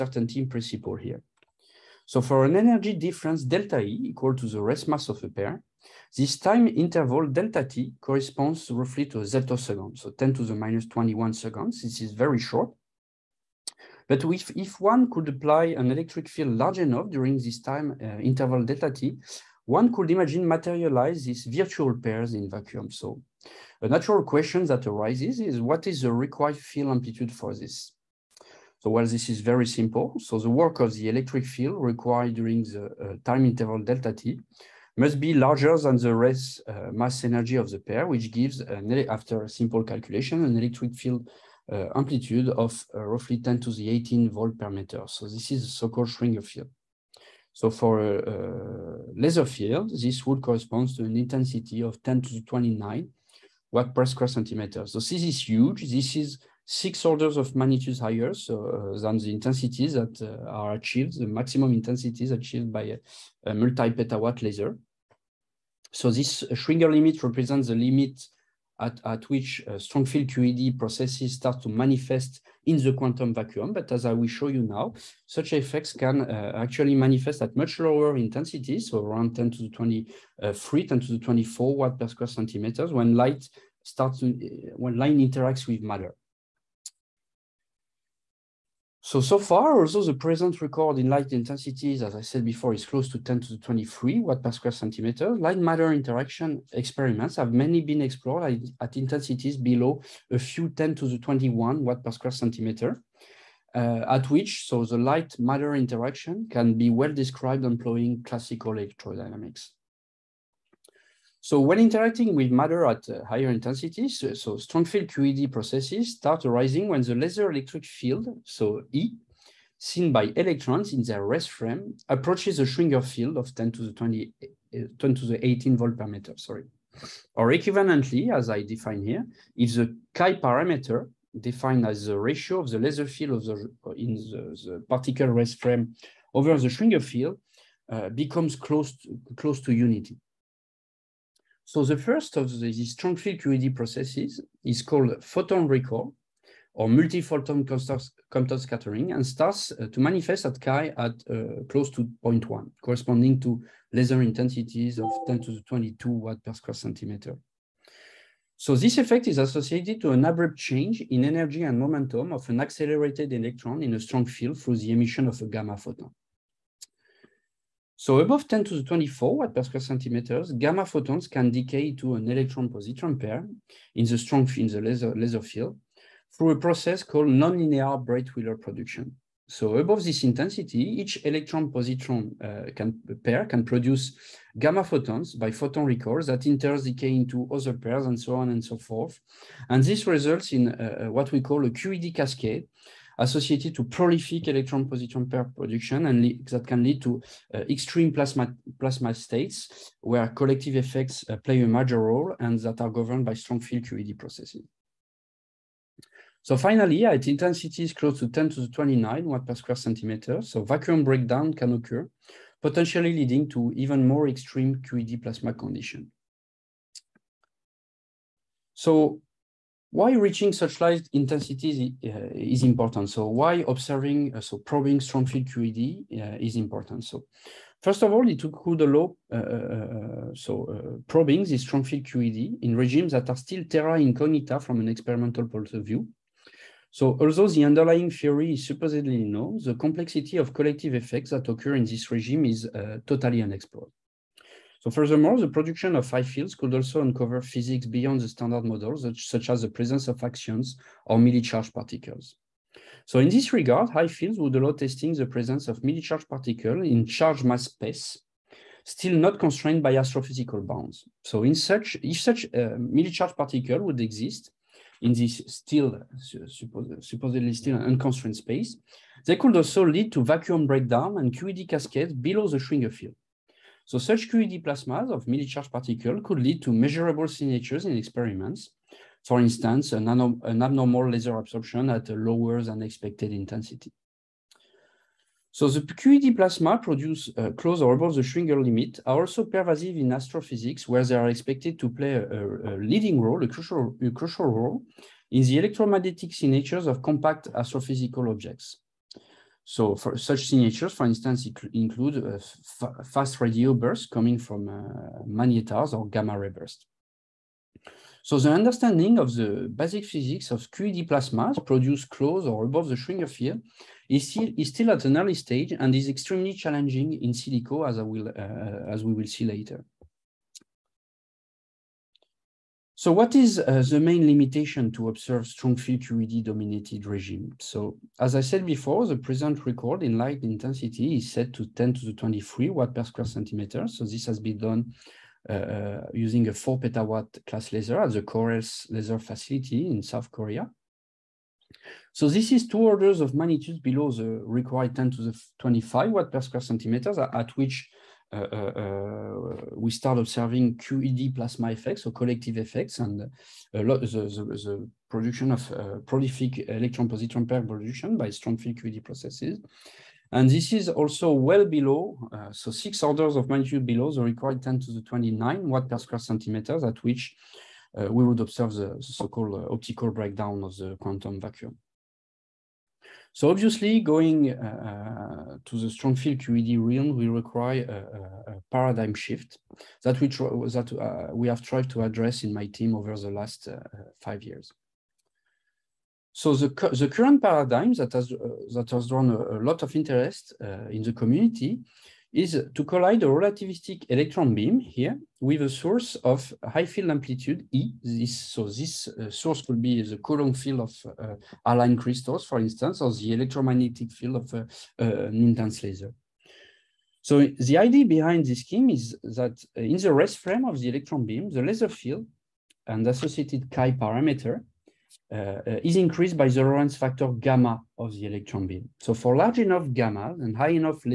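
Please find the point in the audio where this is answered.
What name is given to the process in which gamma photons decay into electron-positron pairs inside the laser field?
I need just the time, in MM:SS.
02:57.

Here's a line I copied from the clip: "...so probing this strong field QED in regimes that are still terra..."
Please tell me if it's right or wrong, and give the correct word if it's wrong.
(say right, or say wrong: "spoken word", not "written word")
right.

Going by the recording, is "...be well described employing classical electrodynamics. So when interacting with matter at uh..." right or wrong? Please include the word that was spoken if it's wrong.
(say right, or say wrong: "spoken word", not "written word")
right.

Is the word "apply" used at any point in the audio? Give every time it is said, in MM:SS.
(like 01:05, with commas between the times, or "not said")
00:15.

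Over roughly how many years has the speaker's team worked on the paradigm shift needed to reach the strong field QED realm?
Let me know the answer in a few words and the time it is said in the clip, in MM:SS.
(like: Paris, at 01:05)
5 years, at 06:24.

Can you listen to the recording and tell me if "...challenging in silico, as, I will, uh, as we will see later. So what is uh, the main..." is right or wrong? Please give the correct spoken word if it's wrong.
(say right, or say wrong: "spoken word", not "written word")
right.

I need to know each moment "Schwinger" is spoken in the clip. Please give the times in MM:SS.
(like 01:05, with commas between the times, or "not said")
00:46, 01:06, 02:02, 02:16, 04:32, 04:48, 05:12.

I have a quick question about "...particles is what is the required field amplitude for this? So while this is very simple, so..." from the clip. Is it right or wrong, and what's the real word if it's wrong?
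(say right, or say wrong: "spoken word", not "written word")
wrong: "arises", not "particles".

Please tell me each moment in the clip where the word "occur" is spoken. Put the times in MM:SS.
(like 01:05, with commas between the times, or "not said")
03:31, 04:01.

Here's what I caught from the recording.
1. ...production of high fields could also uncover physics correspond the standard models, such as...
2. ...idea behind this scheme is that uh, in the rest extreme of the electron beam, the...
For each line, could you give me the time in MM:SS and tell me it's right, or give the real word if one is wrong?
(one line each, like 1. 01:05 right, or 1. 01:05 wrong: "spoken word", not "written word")
1. 04:05 wrong: "beyond", not "correspond"
2. 06:47 wrong: "frame", not "extreme".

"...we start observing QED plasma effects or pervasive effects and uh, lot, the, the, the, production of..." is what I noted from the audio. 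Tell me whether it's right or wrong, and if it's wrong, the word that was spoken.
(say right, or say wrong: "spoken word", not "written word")
wrong: "collective", not "pervasive".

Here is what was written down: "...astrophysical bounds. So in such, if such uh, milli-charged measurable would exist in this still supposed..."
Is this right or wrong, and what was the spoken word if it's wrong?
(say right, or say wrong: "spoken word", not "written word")
wrong: "particle", not "measurable".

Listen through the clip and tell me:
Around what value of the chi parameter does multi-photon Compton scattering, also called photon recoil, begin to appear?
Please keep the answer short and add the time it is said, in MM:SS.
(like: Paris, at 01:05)
0.1, at 02:32.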